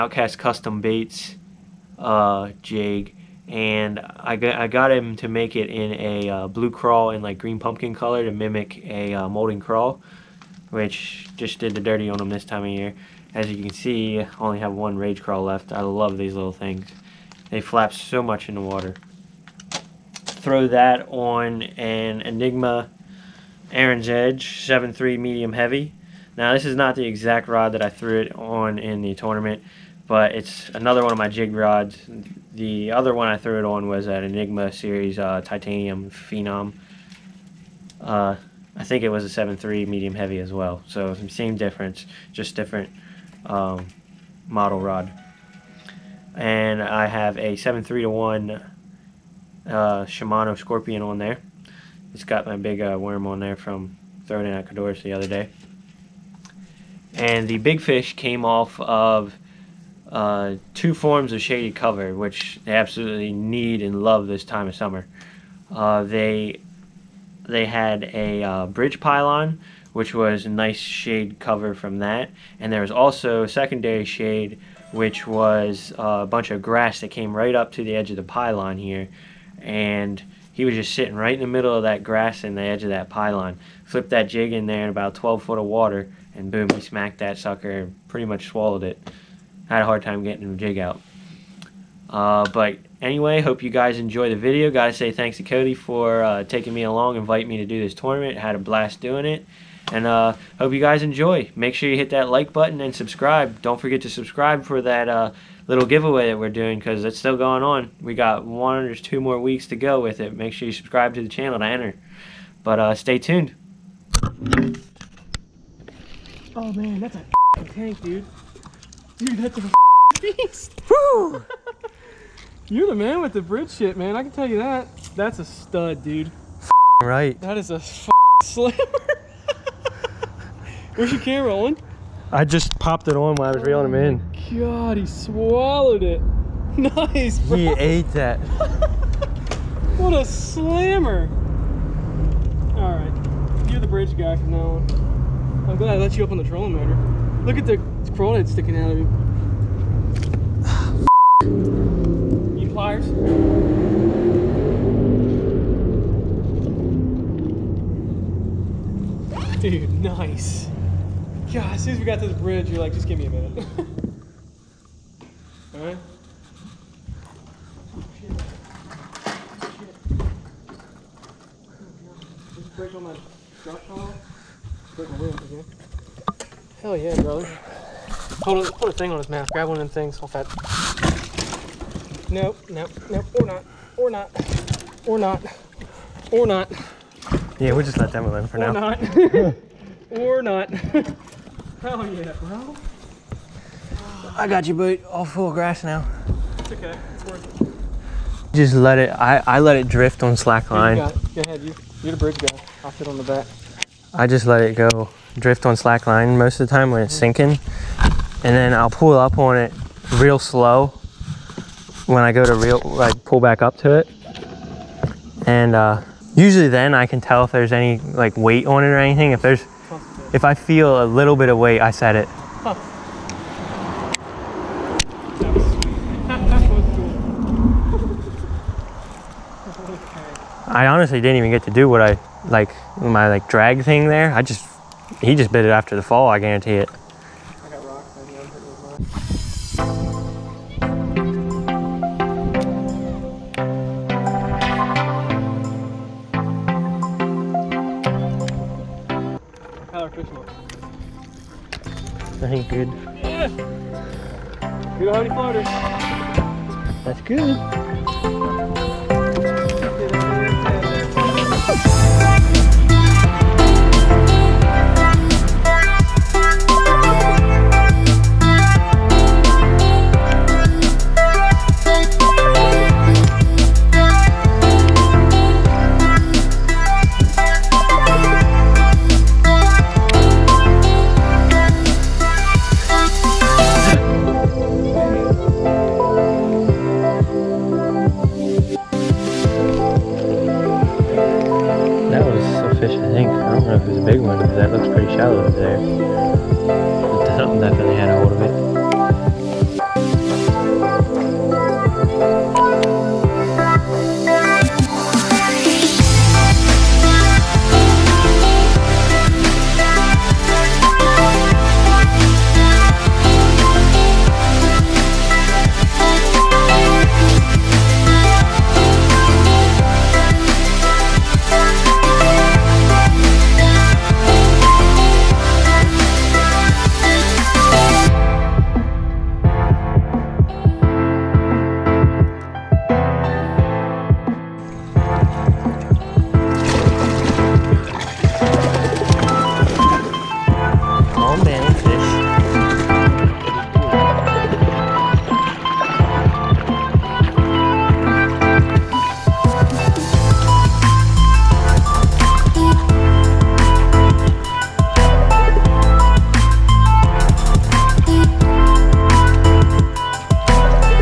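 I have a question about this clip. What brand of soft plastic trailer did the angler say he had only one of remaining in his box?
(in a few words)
Rage Craw.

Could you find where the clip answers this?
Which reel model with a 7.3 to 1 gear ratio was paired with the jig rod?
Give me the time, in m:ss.
0:50.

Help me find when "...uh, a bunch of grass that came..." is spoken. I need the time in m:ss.
1:15.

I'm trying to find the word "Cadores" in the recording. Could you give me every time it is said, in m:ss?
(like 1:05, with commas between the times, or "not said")
0:54.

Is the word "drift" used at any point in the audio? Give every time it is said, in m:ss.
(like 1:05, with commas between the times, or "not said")
3:19, 3:25.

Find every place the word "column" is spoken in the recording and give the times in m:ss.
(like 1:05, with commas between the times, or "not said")
not said.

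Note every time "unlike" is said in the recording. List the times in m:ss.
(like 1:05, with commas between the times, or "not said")
not said.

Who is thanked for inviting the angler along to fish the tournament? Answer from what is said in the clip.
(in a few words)
Cody.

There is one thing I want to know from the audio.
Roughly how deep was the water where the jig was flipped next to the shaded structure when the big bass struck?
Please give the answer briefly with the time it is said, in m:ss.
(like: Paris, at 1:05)
12 feet, at 1:25.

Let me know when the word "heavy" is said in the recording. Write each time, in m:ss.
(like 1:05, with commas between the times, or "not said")
0:25, 0:40.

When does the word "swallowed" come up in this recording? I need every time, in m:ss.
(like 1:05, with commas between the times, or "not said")
1:28, 2:15.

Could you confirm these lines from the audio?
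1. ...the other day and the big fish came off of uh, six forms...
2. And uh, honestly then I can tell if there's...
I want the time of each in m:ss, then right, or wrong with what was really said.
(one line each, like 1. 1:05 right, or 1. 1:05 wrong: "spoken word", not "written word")
1. 0:55 wrong: "two", not "six"
2. 3:35 wrong: "usually", not "honestly".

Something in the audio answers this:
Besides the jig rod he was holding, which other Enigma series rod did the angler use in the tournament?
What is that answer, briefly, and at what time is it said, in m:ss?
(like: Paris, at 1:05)
Titanium Phenom, at 0:35.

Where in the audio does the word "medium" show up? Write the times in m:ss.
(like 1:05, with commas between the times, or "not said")
0:25, 0:39.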